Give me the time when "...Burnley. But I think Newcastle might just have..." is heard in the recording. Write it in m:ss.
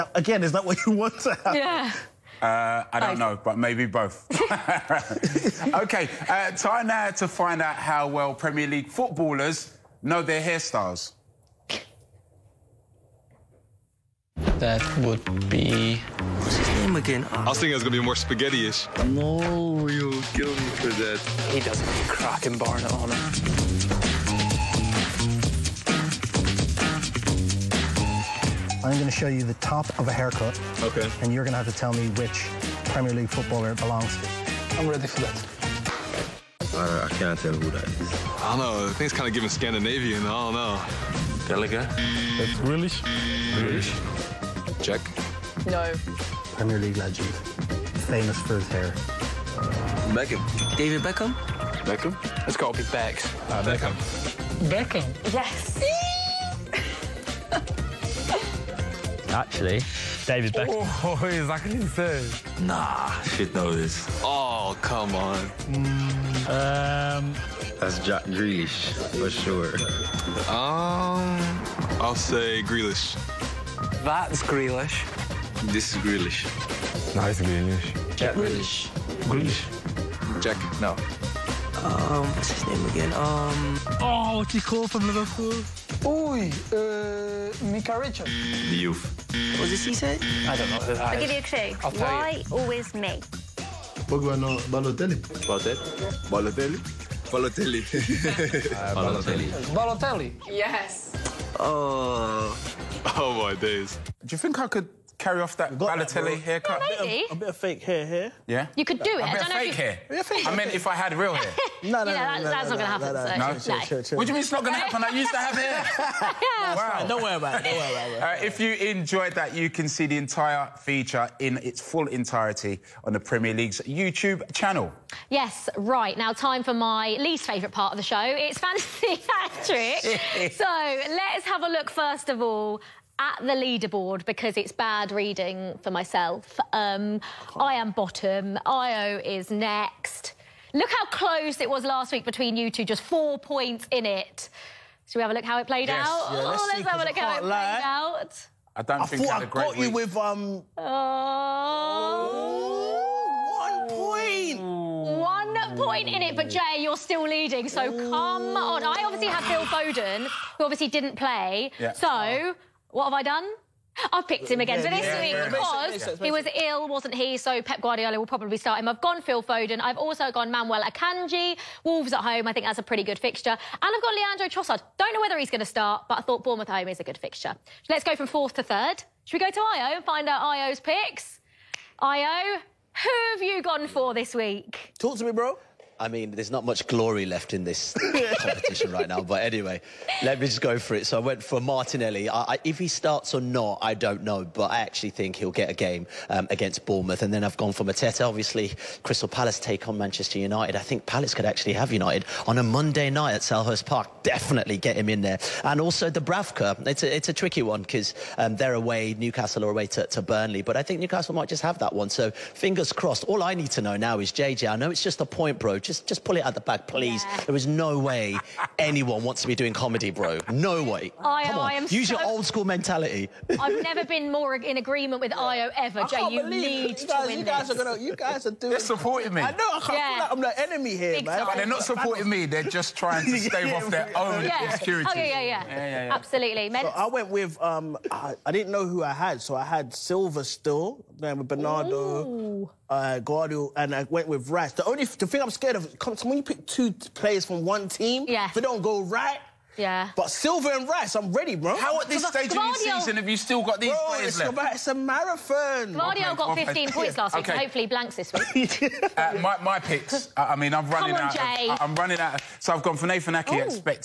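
3:30.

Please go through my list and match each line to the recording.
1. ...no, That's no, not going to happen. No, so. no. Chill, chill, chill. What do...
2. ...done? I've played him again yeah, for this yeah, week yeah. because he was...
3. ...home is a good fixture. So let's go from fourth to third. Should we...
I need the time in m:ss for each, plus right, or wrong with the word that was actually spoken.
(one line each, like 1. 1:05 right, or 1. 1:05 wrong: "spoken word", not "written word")
1. 1:52 right
2. 2:43 wrong: "picked", not "played"
3. 2:56 right.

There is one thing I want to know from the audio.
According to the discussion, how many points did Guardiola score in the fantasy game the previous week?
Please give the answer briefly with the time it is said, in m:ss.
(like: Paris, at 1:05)
15, at 4:16.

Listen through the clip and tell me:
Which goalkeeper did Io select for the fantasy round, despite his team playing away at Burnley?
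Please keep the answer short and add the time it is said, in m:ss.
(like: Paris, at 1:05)
Dubravka, at 3:26.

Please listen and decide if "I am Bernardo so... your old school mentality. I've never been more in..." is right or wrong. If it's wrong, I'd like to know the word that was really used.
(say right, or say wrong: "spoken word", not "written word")
wrong: "Use", not "Bernardo".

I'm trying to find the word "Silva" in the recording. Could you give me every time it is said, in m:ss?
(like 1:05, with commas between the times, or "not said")
3:59, 4:10.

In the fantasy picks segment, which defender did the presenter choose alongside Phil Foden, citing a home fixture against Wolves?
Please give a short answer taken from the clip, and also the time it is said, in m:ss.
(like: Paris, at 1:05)
Manuel Akanji, at 2:50.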